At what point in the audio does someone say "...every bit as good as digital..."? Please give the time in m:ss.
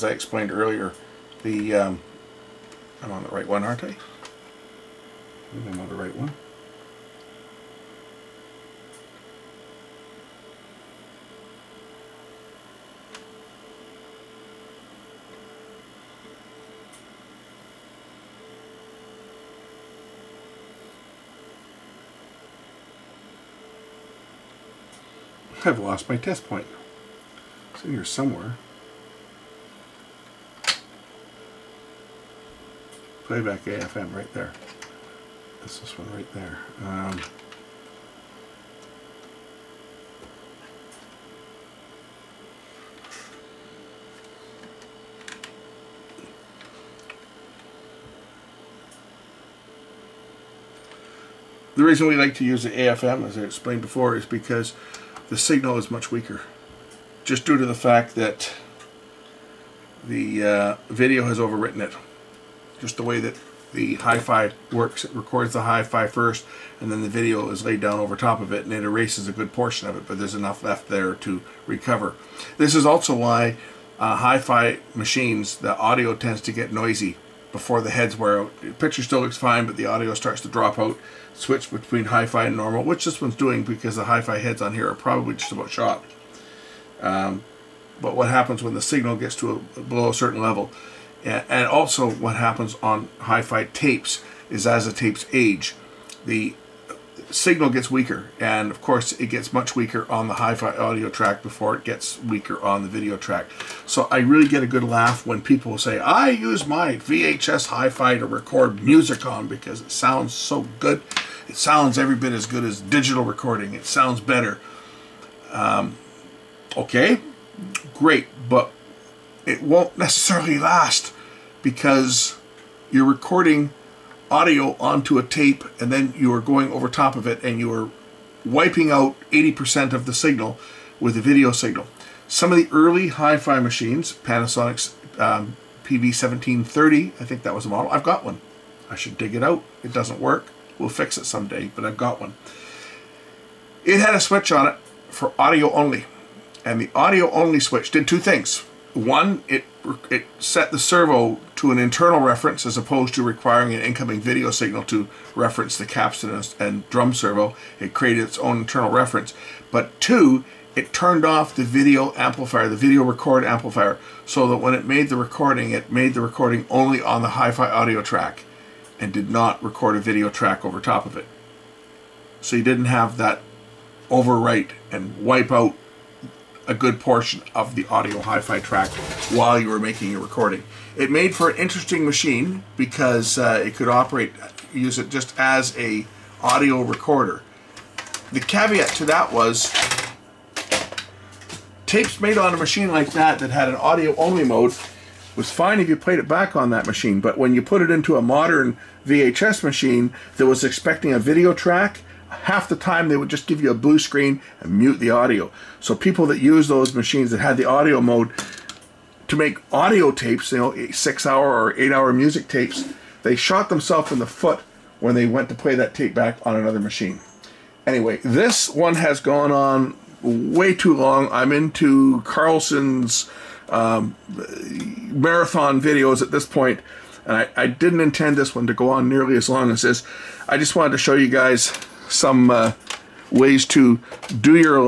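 1:51.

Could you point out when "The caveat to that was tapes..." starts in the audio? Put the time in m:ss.
3:08.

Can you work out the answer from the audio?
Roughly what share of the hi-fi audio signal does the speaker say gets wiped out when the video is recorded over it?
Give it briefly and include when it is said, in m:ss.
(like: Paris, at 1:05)
80%, at 2:09.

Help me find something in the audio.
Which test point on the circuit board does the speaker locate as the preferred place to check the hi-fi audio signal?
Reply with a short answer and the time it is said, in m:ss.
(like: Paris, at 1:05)
Playback AFM, at 0:33.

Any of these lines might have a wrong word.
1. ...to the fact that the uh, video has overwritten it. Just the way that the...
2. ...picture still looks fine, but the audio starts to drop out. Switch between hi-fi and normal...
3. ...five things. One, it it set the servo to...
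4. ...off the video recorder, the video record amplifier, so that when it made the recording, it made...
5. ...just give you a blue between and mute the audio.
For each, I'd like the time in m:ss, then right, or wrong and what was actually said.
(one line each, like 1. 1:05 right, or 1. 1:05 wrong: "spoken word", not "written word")
1. 0:57 right
2. 1:18 right
3. 2:28 wrong: "two", not "five"
4. 2:41 wrong: "amplifier", not "recorder"
5. 3:23 wrong: "screen", not "between".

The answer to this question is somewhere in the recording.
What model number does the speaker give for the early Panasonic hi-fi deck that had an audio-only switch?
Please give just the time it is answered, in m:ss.
2:15.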